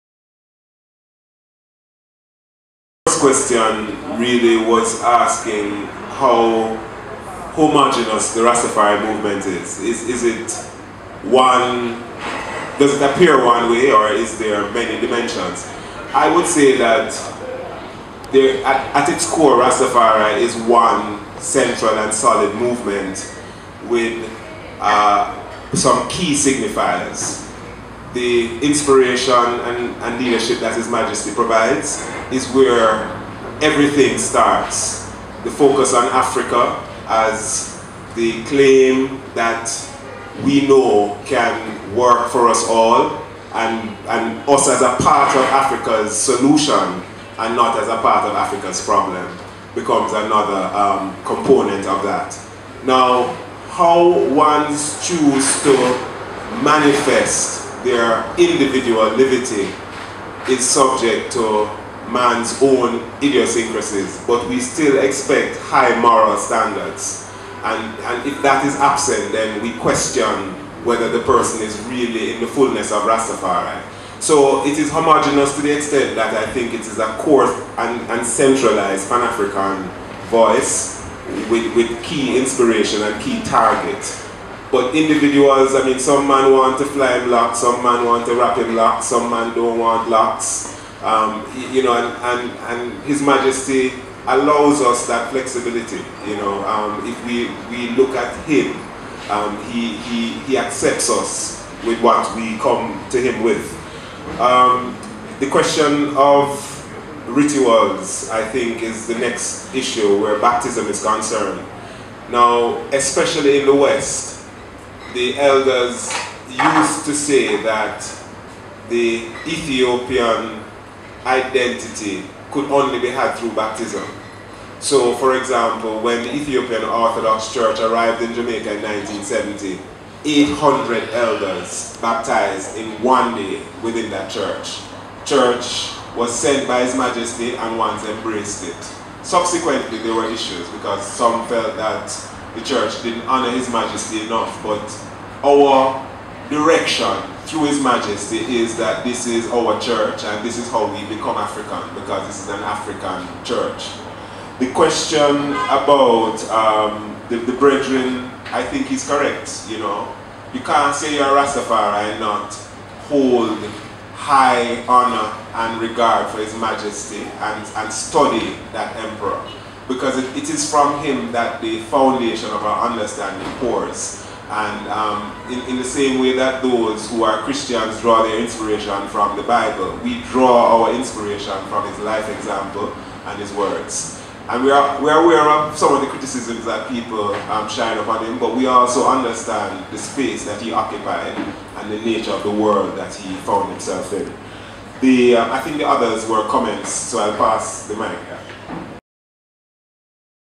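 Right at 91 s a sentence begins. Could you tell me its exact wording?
Um, you know, and, and, and His Majesty allows us that flexibility.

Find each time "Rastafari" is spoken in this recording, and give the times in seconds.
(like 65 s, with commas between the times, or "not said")
8 s, 19 s, 73 s, 161 s.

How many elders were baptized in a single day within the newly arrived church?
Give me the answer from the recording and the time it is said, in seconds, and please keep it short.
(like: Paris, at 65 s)
800, at 130 s.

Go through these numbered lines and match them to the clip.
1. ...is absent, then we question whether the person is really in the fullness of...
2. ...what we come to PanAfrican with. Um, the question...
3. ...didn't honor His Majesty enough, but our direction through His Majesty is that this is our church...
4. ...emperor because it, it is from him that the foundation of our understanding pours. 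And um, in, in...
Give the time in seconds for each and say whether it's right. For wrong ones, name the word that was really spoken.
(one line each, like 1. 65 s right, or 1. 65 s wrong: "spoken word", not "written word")
1. 68 s right
2. 102 s wrong: "Him", not "PanAfrican"
3. 143 s right
4. 168 s right.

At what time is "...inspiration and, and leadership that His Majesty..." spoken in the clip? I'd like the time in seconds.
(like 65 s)
28 s.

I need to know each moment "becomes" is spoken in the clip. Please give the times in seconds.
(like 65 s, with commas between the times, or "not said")
49 s, 151 s.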